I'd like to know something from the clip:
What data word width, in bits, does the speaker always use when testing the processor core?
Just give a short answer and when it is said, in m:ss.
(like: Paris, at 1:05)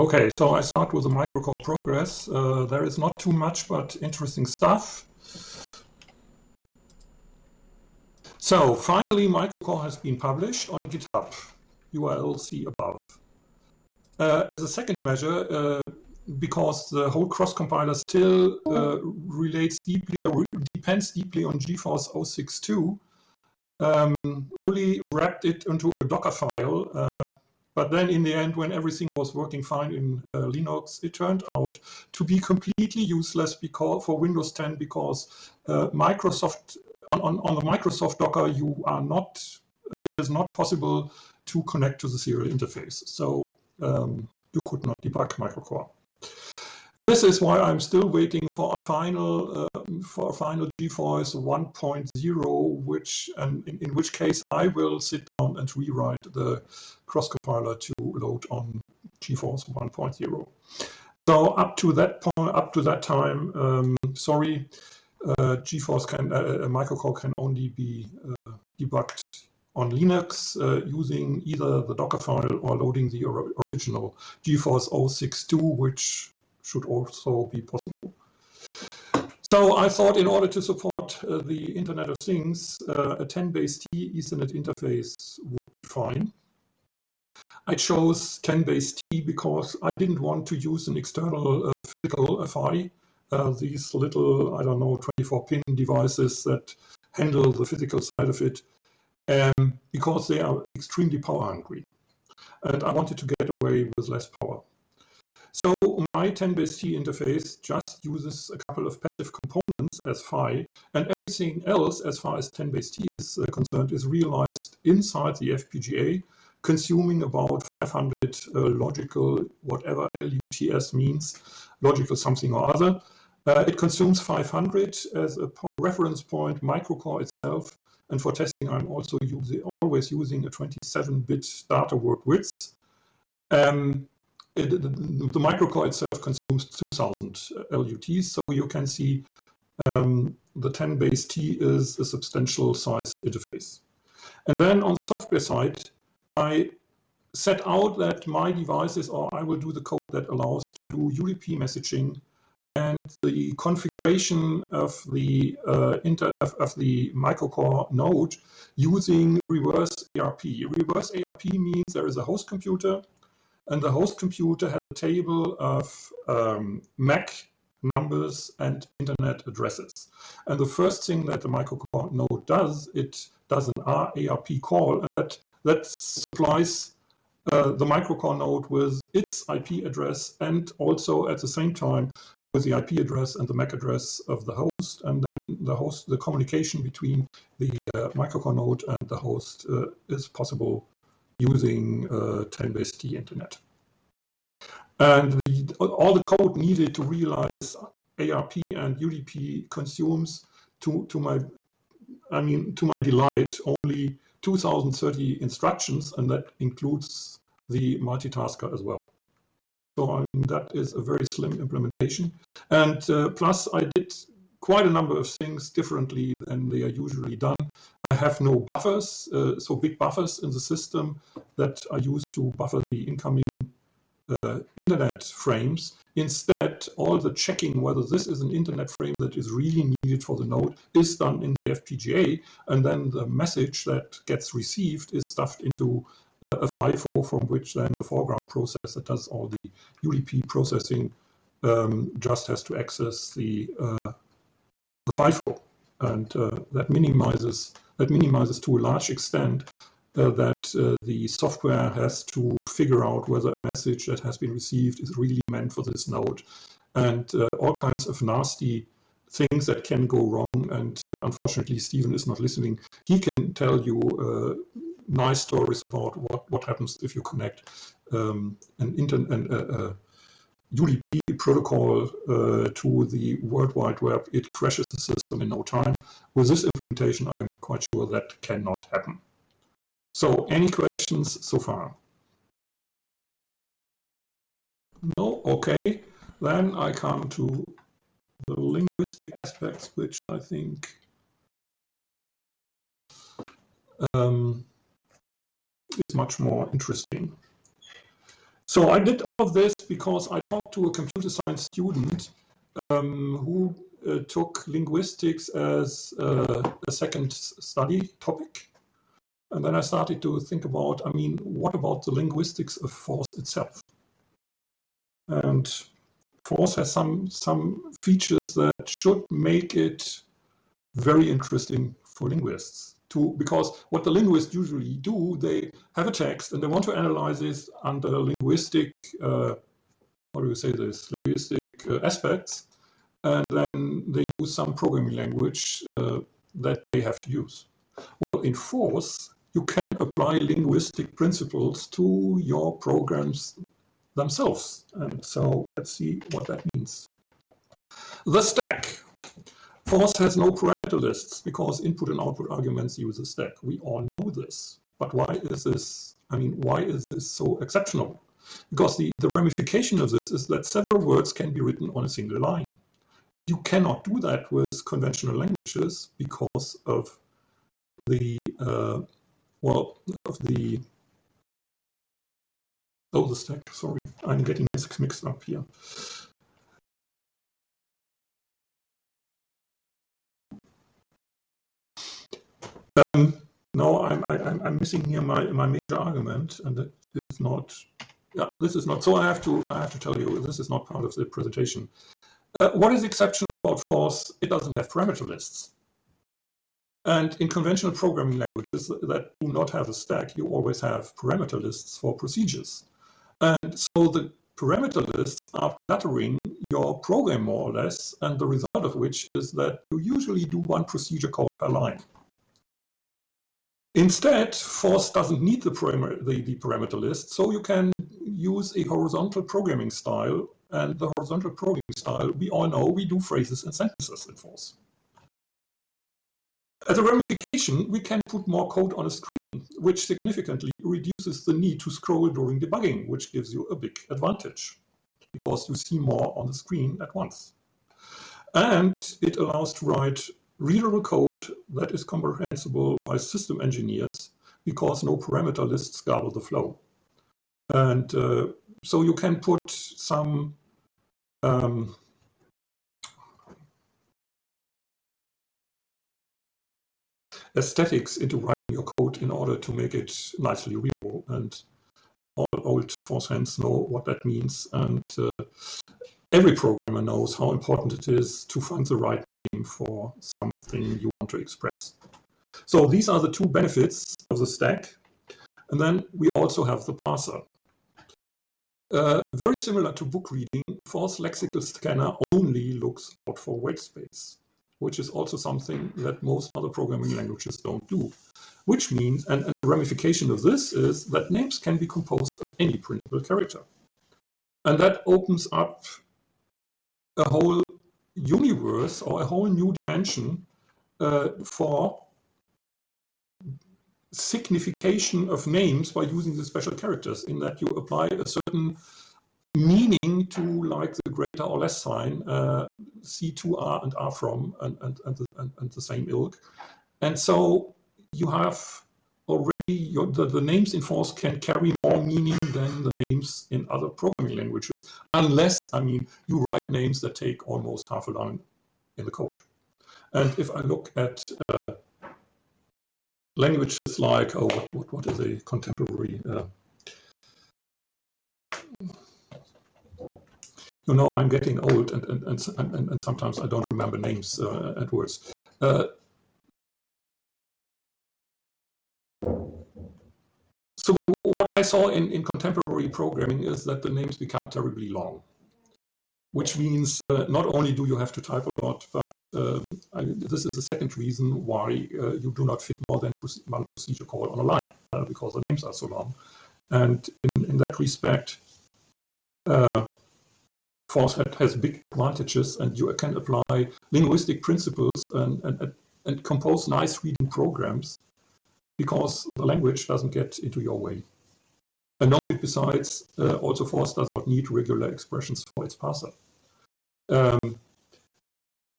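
27, at 2:10.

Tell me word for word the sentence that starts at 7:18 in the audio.
And it allows to write readable code that is comprehensible by system engineers because no parameter lists garble the flow.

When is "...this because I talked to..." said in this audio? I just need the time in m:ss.
4:59.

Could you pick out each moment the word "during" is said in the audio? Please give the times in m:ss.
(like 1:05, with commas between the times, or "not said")
7:12.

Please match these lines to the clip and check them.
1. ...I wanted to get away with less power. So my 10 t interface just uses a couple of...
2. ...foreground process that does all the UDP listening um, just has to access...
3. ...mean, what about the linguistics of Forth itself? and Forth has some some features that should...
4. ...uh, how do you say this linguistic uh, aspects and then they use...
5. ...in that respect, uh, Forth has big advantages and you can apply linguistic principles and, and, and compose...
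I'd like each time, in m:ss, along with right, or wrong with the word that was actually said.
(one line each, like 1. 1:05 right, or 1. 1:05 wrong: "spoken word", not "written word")
1. 1:42 right
2. 3:58 wrong: "processing", not "listening"
3. 5:11 right
4. 5:29 right
5. 9:27 right.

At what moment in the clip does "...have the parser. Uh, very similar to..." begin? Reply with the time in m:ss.
7:56.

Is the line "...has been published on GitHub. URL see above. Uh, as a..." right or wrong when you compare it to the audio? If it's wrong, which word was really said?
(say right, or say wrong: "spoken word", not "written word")
right.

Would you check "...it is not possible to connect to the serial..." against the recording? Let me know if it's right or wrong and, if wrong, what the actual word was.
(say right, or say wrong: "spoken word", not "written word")
right.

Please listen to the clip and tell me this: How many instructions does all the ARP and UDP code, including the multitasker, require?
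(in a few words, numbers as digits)
2030.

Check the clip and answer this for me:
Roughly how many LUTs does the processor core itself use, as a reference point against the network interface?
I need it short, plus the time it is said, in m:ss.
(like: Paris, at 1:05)
2000, at 2:16.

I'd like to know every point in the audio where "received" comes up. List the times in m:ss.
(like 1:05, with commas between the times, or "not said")
3:54, 4:14.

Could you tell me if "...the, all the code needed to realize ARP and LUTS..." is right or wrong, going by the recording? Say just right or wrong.
wrong.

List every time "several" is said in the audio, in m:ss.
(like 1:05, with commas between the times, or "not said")
6:00.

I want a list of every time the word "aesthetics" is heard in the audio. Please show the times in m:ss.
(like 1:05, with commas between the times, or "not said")
7:37.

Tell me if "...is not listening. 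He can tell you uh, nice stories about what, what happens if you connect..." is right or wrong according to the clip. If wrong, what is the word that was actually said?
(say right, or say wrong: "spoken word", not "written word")
right.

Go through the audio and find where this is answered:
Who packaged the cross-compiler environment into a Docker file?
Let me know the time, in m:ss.
0:24.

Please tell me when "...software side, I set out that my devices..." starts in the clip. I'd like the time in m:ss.
2:25.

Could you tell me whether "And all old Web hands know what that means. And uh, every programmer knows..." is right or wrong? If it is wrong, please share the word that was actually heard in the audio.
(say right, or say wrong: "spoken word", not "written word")
wrong: "Forth", not "Web".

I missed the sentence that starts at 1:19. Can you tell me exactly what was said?
So I thought in order to support uh, the Internet of Things, uh, a 10 base T Ethernet interface would be fine.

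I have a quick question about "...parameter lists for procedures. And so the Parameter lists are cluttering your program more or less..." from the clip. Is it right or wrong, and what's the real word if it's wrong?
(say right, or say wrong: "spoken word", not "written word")
right.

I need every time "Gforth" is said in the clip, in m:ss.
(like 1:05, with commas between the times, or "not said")
0:21, 0:50, 0:59, 1:05, 1:14.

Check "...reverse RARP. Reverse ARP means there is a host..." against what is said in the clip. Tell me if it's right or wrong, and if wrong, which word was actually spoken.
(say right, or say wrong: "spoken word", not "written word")
wrong: "ARP", not "RARP".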